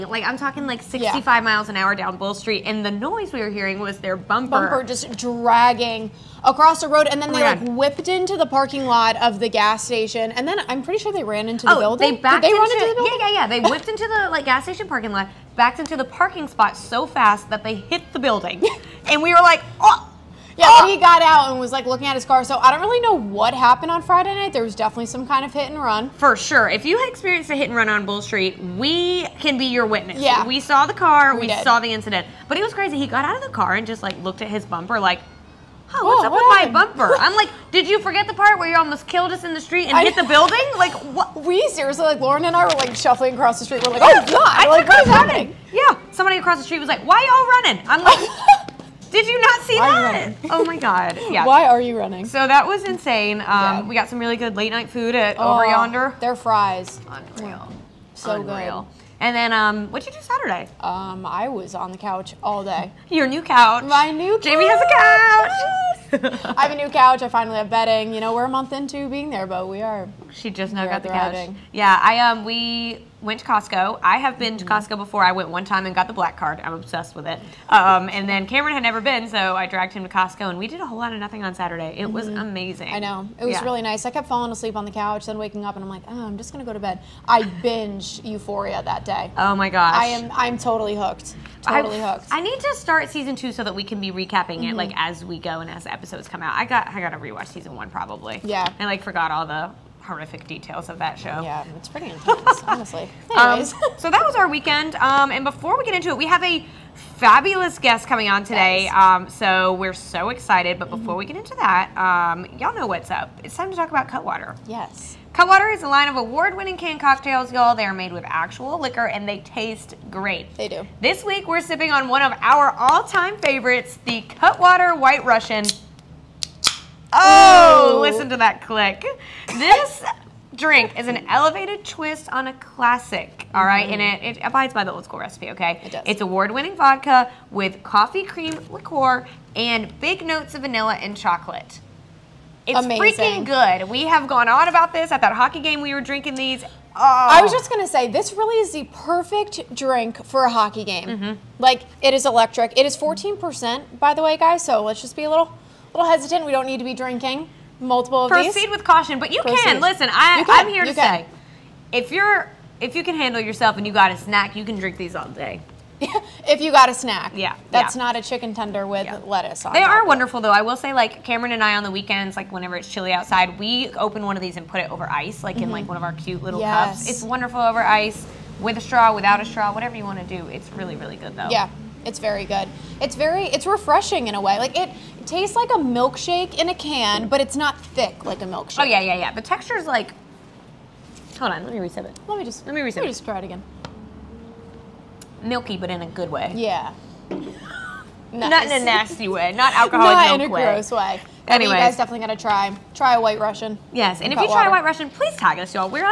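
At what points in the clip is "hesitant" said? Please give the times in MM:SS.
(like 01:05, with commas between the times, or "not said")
02:36.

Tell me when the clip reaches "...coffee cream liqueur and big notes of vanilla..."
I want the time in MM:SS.
02:17.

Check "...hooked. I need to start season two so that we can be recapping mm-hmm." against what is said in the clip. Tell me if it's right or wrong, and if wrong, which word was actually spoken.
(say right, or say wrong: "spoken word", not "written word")
right.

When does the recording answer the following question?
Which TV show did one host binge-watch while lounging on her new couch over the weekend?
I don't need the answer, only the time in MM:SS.
01:28.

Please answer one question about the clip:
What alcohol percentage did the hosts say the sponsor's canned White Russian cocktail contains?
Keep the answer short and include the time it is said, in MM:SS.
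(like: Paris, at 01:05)
14%, at 02:32.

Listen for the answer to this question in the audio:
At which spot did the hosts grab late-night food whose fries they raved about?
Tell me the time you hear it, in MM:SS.
00:55.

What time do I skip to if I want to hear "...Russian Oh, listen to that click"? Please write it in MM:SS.
02:05.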